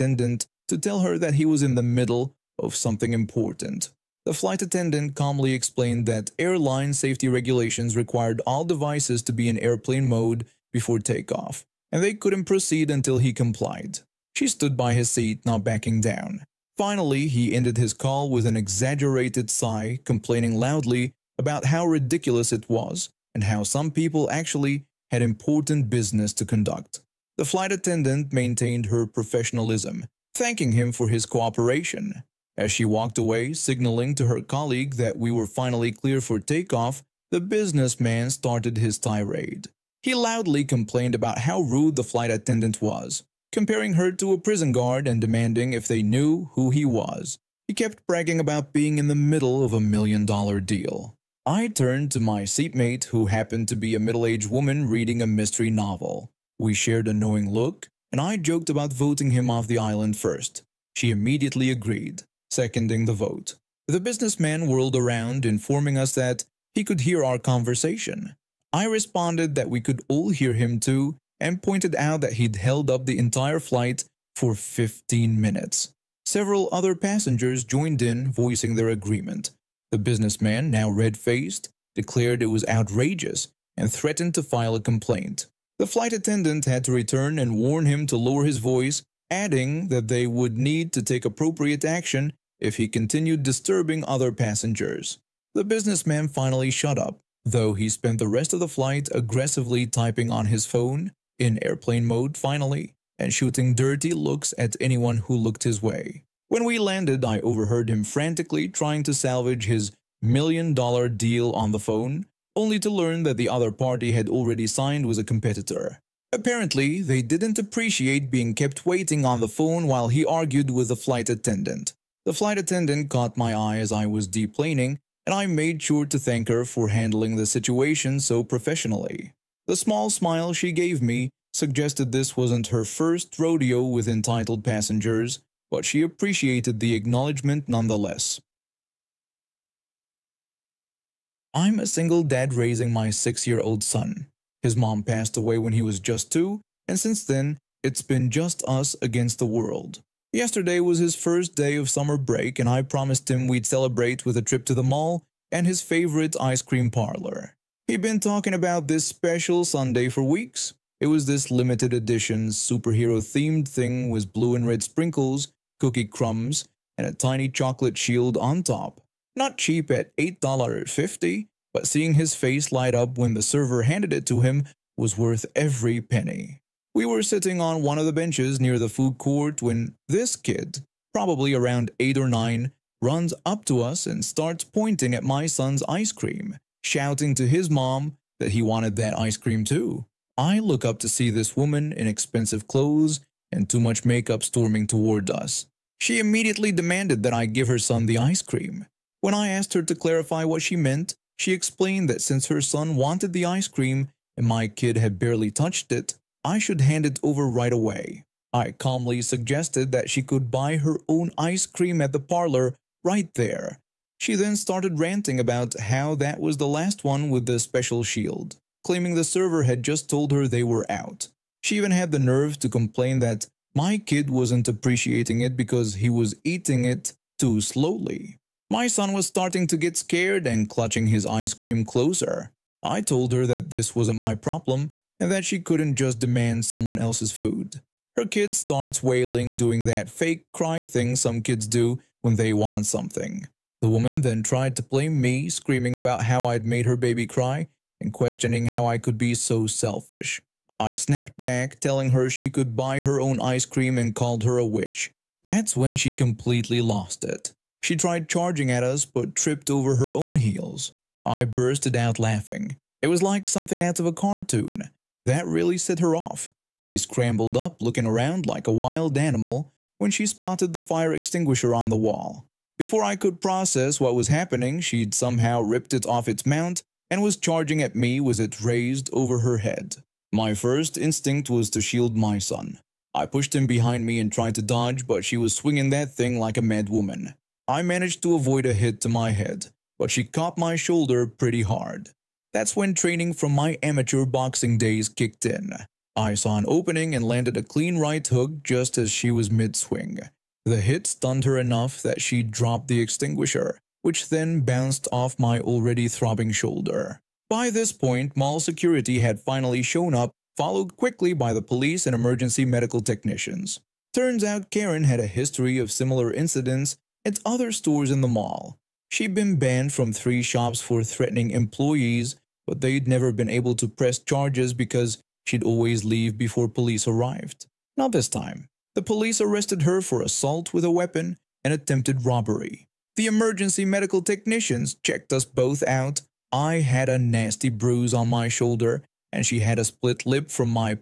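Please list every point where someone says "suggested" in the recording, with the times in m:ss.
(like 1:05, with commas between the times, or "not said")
2:11, 3:29.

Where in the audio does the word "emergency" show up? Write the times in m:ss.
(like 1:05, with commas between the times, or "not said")
5:12, 5:33.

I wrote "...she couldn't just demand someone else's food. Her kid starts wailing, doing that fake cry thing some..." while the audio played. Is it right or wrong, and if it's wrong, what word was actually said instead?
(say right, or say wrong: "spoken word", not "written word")
right.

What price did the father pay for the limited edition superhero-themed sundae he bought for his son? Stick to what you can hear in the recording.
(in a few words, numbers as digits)
$8.50.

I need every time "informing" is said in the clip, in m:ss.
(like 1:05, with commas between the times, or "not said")
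1:05.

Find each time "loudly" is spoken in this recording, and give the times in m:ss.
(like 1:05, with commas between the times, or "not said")
0:20, 0:40.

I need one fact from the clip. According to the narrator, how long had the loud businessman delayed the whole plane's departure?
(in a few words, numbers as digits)
15 minutes.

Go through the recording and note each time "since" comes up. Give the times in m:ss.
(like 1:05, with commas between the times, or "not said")
2:26, 3:22.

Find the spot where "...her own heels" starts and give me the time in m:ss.
4:19.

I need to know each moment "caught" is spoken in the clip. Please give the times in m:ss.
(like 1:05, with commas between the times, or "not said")
2:03, 4:50.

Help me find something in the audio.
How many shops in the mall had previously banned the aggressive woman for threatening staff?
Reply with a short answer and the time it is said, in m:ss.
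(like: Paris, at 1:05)
3, at 5:20.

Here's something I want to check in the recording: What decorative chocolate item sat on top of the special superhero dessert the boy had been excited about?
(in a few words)
chocolate shield.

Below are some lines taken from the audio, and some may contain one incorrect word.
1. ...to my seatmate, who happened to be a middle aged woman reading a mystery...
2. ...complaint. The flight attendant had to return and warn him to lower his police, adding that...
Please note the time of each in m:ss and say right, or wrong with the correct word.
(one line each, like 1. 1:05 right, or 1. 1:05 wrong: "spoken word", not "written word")
1. 0:52 right
2. 1:24 wrong: "voice", not "police".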